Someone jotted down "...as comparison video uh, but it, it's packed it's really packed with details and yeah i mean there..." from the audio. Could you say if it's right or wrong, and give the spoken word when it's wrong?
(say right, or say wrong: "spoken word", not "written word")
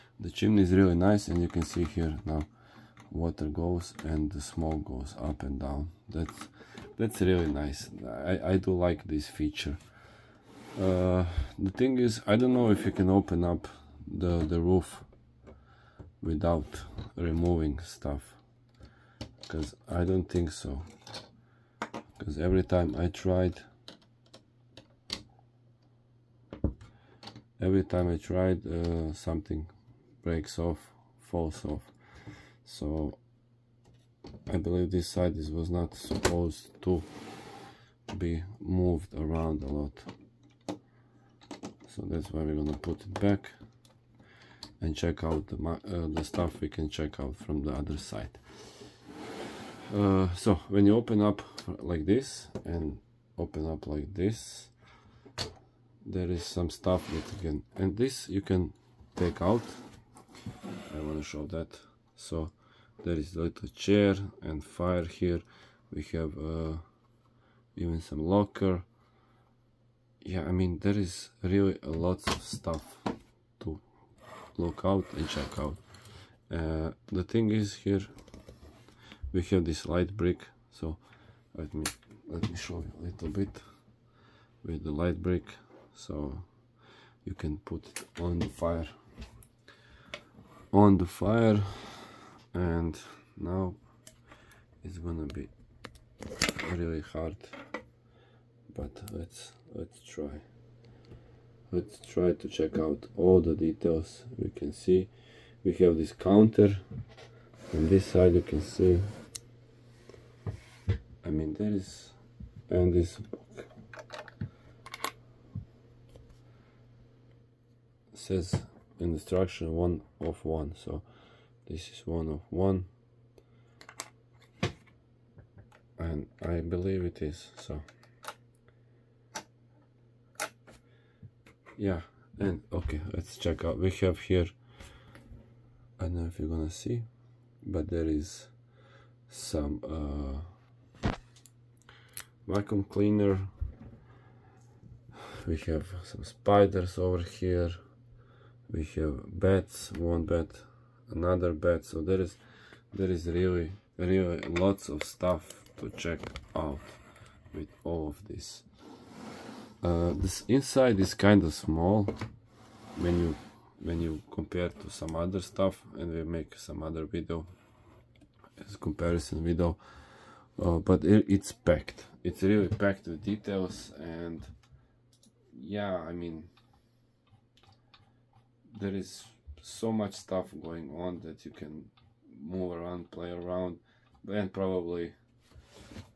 right.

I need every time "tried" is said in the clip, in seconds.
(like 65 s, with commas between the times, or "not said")
23 s, 28 s.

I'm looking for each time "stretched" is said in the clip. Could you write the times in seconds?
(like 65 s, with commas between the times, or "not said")
not said.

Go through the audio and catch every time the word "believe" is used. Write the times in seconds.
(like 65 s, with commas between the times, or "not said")
34 s, 126 s.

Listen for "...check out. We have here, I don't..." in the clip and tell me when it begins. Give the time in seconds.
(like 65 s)
133 s.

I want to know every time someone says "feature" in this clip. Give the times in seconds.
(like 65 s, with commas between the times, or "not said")
9 s.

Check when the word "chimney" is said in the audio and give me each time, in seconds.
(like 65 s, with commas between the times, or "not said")
0 s.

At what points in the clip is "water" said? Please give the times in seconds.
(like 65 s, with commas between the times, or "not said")
3 s.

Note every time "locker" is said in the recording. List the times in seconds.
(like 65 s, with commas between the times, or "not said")
68 s.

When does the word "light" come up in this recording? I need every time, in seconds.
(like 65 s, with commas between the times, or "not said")
79 s, 84 s.